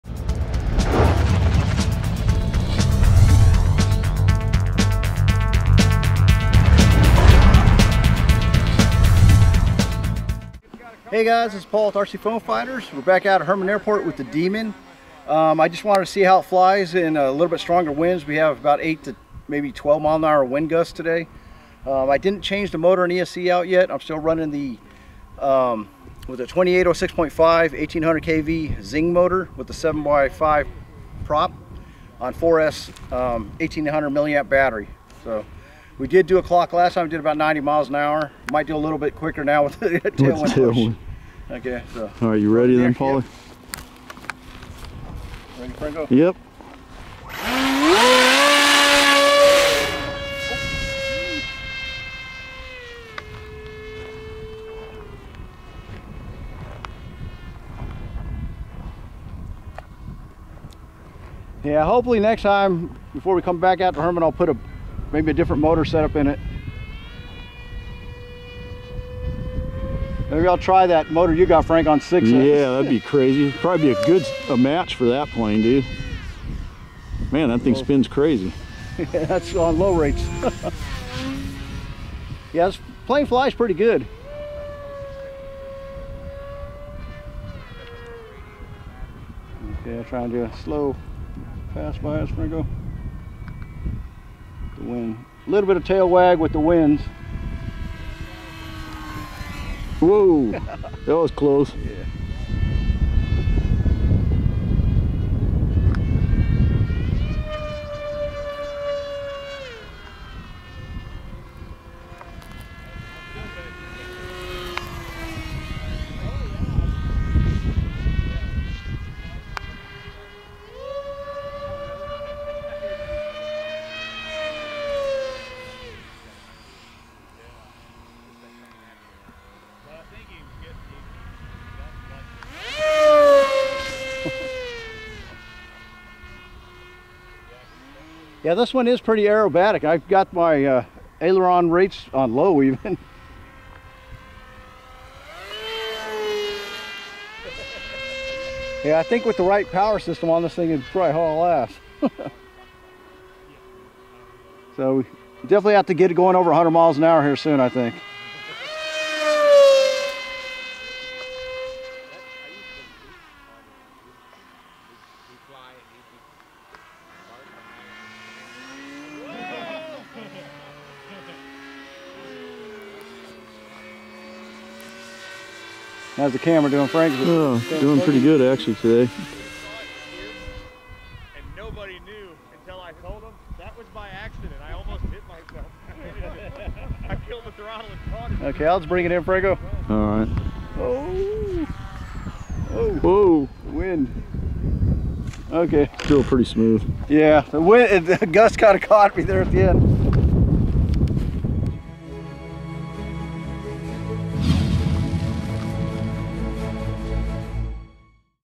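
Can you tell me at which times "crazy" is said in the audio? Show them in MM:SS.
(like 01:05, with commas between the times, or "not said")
01:13, 01:18.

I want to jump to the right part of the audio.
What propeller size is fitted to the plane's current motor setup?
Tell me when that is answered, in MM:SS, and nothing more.
00:29.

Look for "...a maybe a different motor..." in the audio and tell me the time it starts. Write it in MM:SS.
01:04.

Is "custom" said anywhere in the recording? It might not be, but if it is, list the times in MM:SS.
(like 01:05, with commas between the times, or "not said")
not said.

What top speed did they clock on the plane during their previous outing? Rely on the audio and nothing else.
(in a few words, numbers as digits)
90 miles an hour.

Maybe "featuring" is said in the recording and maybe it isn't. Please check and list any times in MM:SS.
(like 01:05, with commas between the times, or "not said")
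not said.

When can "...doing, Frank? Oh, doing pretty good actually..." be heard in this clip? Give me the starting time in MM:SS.
02:56.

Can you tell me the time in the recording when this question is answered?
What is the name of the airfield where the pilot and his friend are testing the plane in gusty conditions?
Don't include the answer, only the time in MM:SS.
00:13.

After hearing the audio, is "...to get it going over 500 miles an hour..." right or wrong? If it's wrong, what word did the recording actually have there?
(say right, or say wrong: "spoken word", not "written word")
wrong: "100", not "500".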